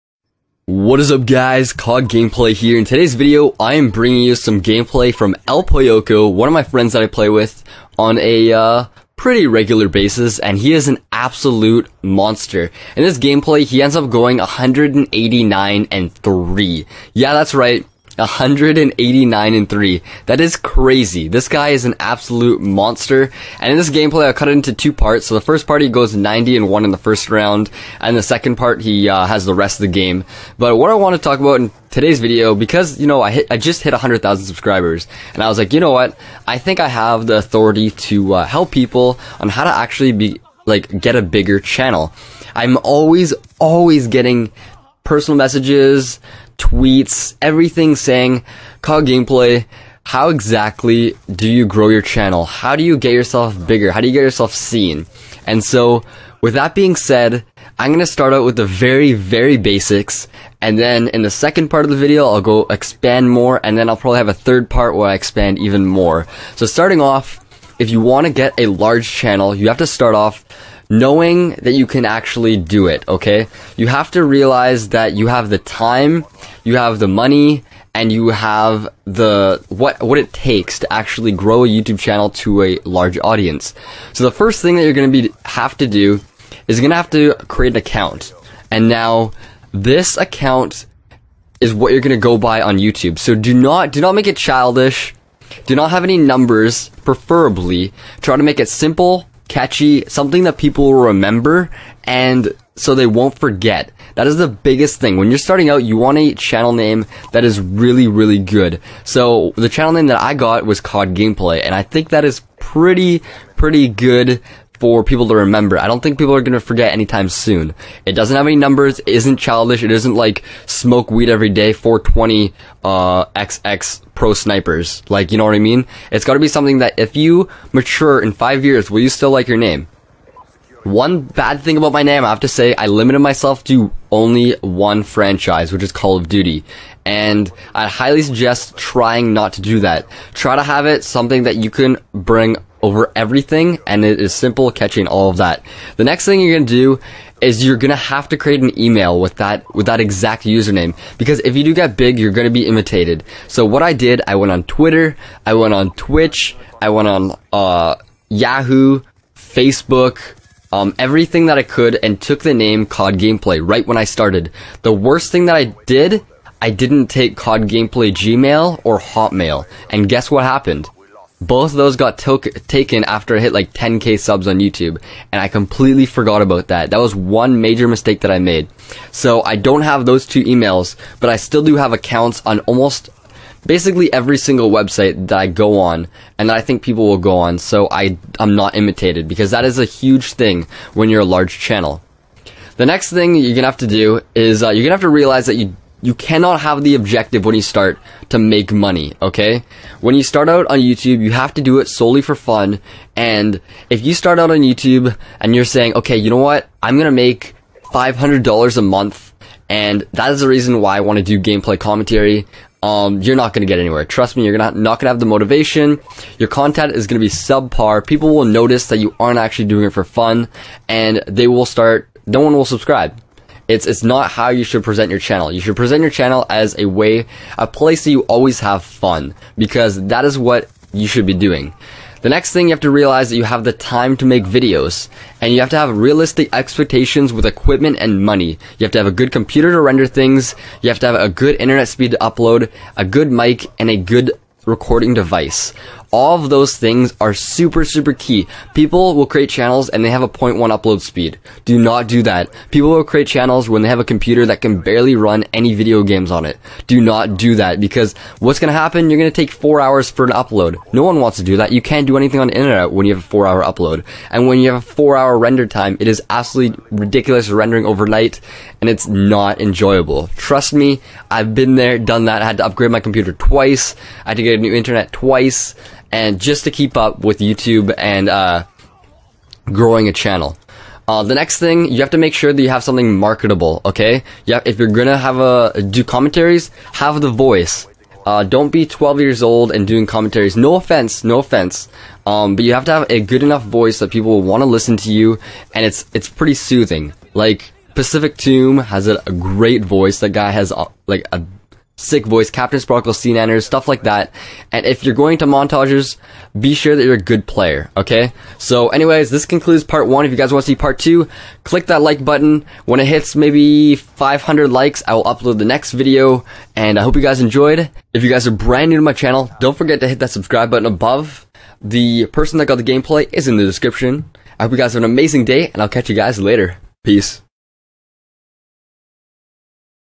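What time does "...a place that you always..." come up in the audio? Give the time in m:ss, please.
3:47.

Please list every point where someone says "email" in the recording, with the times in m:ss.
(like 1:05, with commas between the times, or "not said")
2:28, 3:00.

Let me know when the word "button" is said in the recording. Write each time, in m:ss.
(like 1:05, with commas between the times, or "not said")
5:12, 5:20.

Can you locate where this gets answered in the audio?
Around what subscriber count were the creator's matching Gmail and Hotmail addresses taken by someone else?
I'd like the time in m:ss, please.
2:53.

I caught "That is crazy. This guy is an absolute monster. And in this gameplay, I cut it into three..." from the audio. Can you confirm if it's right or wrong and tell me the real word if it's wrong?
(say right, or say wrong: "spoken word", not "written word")
wrong: "two", not "three".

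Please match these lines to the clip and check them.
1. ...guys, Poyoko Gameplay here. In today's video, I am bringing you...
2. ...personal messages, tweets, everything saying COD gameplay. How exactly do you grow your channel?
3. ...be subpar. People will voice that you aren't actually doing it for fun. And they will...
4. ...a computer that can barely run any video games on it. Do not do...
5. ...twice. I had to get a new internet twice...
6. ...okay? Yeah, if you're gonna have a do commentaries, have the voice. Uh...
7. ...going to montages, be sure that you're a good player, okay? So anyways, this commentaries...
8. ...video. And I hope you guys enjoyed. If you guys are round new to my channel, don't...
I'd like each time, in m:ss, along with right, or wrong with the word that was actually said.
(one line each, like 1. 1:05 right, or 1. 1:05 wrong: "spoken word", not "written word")
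1. 0:01 wrong: "COD", not "Poyoko"
2. 0:45 right
3. 3:37 wrong: "notice", not "voice"
4. 4:13 right
5. 4:33 right
6. 4:43 right
7. 5:05 wrong: "concludes", not "commentaries"
8. 5:15 wrong: "brand", not "round".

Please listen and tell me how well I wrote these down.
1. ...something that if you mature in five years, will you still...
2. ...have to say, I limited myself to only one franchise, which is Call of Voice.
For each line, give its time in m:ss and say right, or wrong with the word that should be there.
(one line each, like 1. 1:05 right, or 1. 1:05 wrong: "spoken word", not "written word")
1. 2:06 right
2. 2:12 wrong: "Duty", not "Voice".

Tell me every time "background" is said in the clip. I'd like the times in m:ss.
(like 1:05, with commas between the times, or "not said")
not said.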